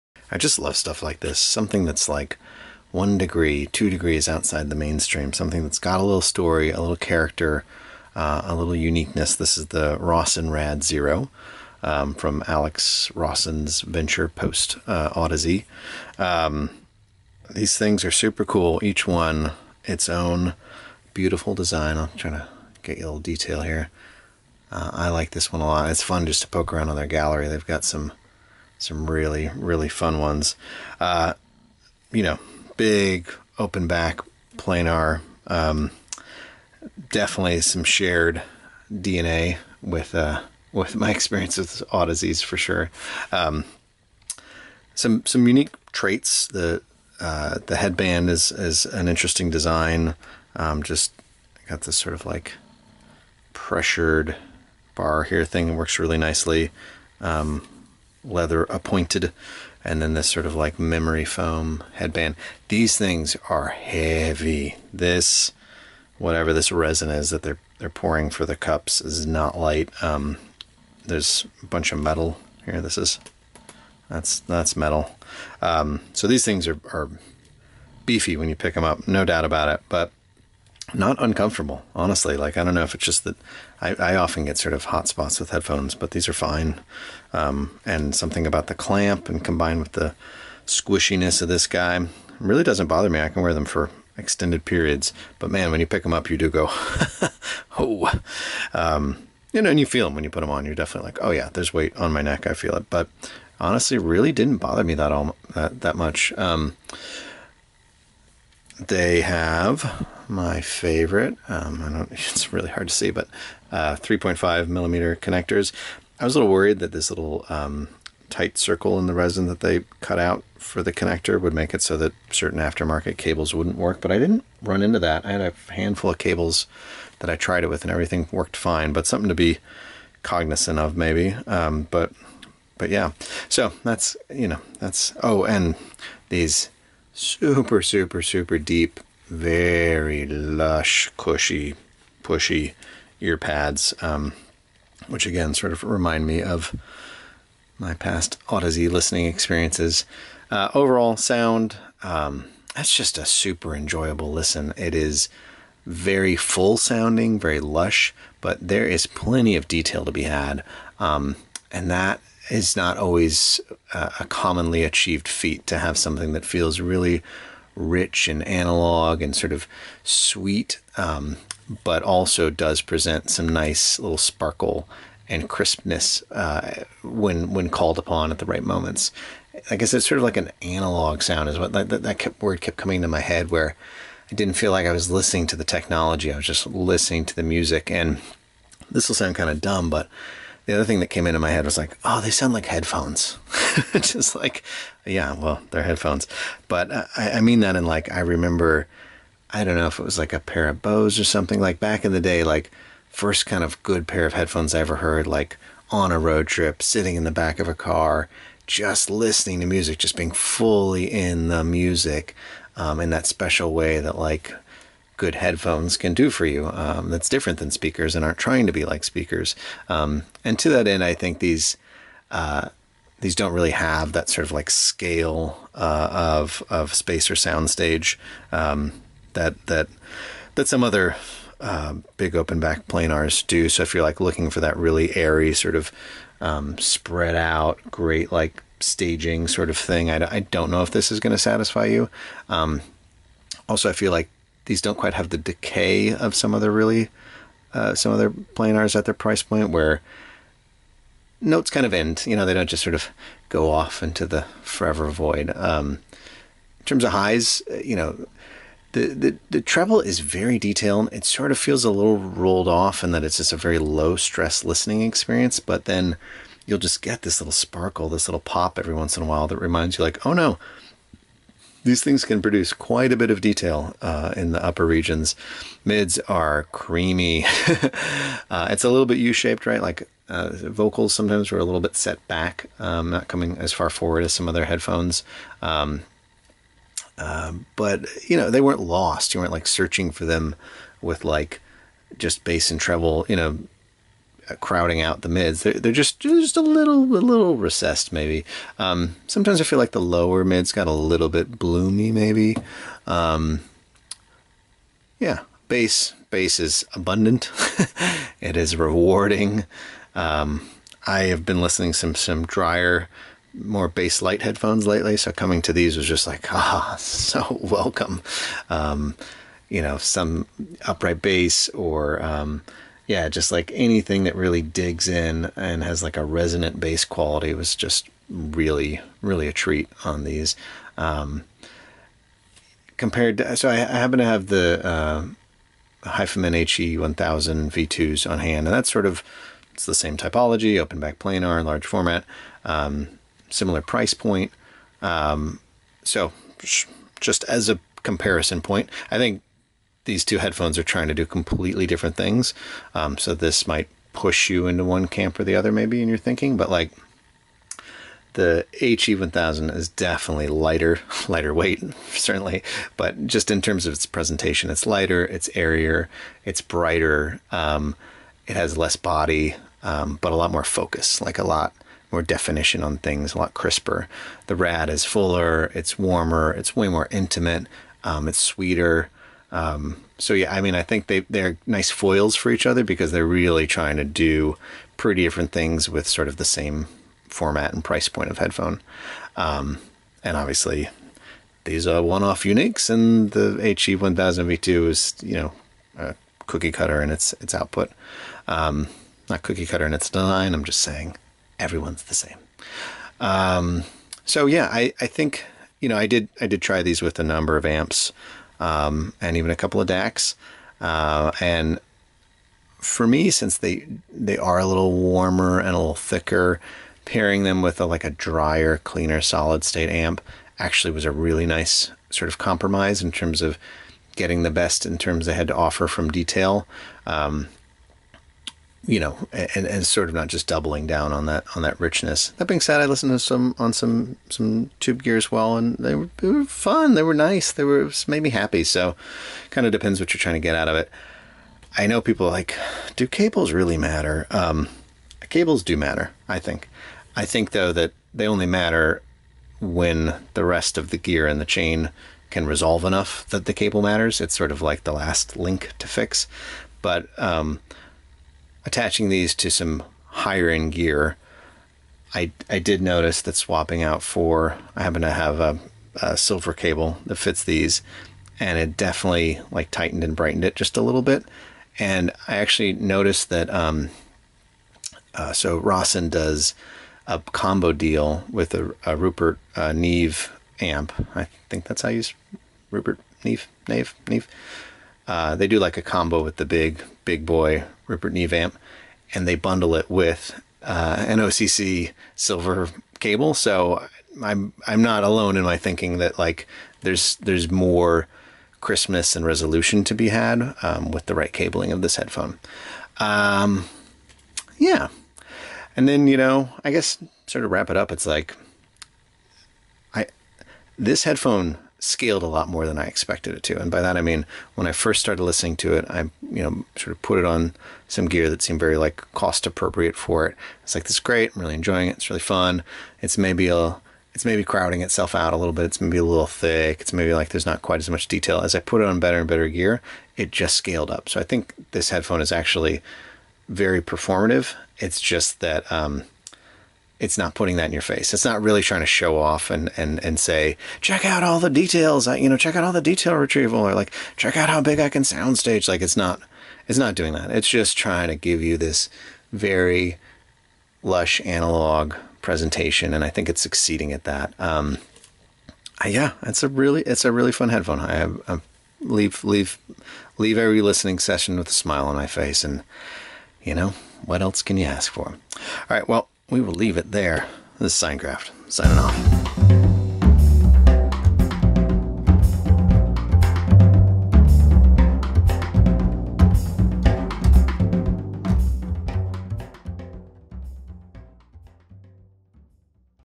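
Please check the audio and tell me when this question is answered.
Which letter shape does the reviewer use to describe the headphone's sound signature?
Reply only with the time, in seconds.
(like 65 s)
279 s.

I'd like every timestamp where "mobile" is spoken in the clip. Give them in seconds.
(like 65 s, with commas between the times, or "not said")
not said.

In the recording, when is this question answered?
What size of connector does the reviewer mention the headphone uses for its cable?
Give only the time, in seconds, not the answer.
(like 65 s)
113 s.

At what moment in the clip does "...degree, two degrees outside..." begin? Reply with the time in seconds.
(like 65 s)
3 s.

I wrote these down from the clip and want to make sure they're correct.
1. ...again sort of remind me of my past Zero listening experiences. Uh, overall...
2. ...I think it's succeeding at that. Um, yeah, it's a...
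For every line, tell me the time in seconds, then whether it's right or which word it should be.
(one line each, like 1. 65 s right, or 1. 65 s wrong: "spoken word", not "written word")
1. 145 s wrong: "Audeze", not "Zero"
2. 553 s right.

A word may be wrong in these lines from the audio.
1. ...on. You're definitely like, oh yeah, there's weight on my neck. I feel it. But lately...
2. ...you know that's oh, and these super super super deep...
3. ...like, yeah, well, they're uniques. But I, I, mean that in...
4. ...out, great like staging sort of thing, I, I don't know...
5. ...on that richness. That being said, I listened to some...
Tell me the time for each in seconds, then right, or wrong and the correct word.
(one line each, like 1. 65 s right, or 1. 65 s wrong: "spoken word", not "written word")
1. 100 s wrong: "honestly", not "lately"
2. 134 s right
3. 194 s wrong: "headphones", not "uniques"
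4. 237 s right
5. 431 s right.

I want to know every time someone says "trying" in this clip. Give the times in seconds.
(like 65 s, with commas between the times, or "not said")
22 s, 218 s, 350 s, 383 s, 440 s, 538 s, 547 s.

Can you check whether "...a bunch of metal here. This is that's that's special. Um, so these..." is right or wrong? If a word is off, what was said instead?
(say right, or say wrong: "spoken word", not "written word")
wrong: "metal", not "special".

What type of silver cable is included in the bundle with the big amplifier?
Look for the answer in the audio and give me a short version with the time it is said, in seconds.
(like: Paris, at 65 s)
OCC silver cable, at 491 s.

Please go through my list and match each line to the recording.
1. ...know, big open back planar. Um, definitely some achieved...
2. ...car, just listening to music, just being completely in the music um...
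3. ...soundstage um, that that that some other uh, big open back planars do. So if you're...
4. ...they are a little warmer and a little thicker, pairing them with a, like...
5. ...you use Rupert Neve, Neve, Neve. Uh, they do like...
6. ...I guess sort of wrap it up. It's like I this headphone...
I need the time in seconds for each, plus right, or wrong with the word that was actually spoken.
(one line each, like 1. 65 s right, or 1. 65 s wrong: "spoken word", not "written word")
1. 32 s wrong: "shared", not "achieved"
2. 207 s wrong: "fully", not "completely"
3. 227 s right
4. 414 s right
5. 481 s right
6. 506 s right.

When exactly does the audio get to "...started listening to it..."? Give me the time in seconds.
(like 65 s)
515 s.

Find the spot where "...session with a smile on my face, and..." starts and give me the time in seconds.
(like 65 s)
560 s.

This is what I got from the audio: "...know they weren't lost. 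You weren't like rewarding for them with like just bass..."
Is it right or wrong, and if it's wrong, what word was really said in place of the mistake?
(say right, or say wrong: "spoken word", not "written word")
wrong: "searching", not "rewarding".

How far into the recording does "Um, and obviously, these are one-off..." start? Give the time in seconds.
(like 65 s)
389 s.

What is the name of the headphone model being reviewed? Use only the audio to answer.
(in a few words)
Rosson Rad Zero.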